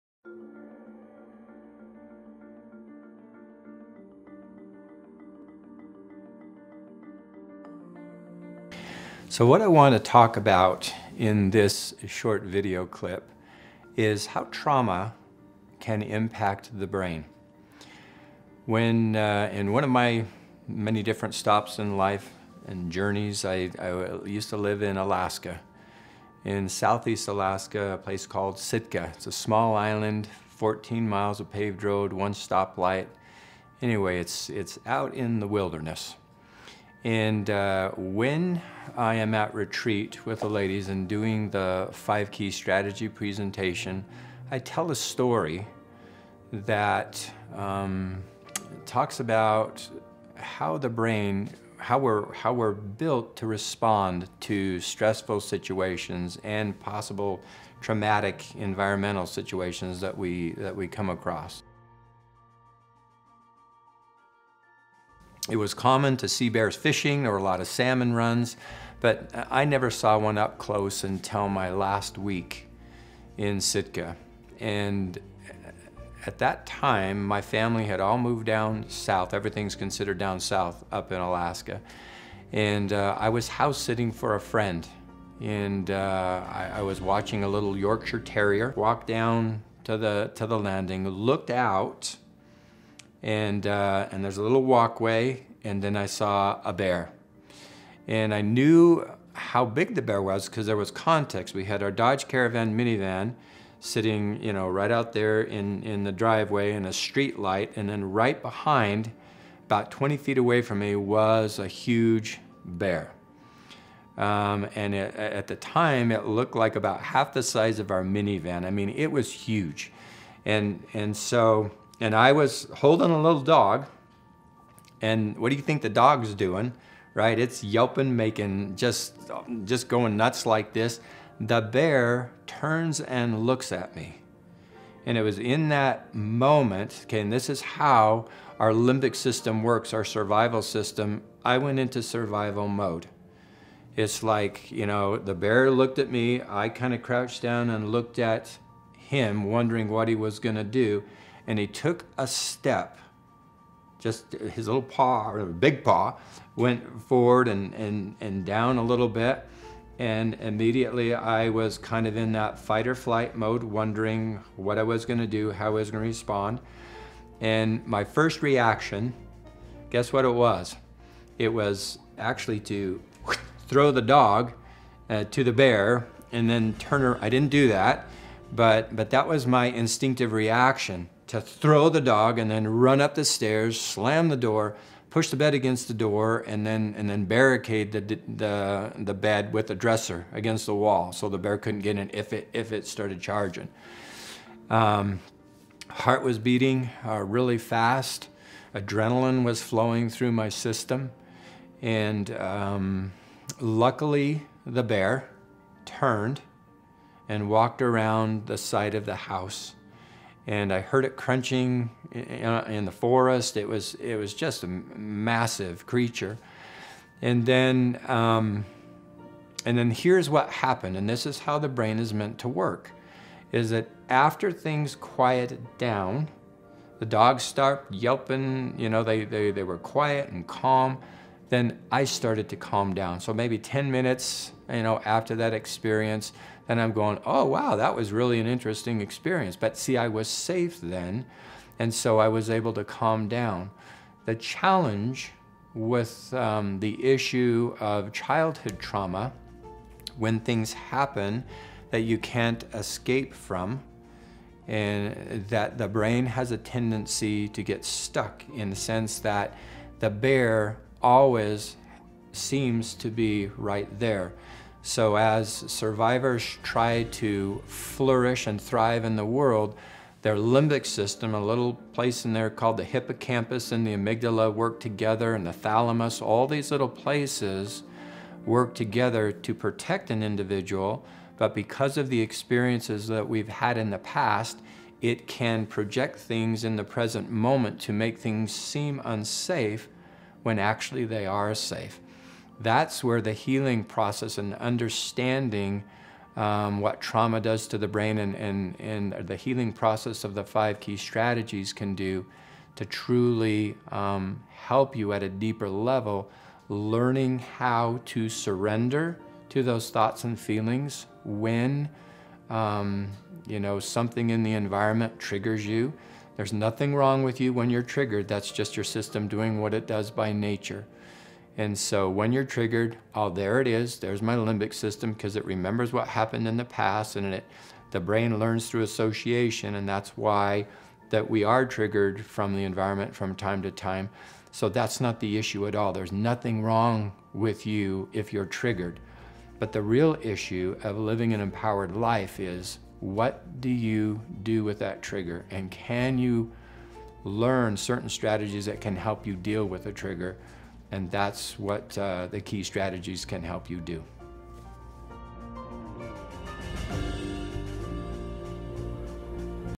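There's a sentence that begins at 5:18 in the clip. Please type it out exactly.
That's just your system doing what it does by nature.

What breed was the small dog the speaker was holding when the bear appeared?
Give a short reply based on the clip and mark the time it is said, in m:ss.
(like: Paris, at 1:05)
Yorkshire Terrier, at 1:27.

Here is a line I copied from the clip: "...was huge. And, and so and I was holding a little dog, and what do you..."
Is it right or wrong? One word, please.
right.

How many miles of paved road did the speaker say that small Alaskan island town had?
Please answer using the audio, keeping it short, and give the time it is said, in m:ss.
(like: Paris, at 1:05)
14, at 0:30.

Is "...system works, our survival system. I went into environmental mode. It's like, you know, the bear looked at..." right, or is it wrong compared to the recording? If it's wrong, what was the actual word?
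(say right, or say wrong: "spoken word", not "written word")
wrong: "survival", not "environmental".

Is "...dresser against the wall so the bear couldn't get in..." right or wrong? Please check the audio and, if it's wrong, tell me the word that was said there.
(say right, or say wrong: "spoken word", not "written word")
right.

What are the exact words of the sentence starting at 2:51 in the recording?
It was actually to throw the dog uh, to the bear and then turn her.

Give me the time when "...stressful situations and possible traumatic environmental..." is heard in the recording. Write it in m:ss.
0:54.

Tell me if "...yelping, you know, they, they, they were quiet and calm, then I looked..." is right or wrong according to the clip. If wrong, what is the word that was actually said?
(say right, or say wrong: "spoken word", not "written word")
wrong: "started", not "looked".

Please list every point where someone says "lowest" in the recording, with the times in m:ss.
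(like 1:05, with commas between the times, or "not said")
not said.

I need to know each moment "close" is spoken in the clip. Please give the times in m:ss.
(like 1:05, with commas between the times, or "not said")
1:10.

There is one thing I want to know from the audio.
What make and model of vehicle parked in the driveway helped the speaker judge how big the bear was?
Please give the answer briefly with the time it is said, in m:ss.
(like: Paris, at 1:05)
Dodge Caravan, at 1:41.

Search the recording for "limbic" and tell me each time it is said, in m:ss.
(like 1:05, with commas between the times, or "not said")
2:18, 4:30, 5:24.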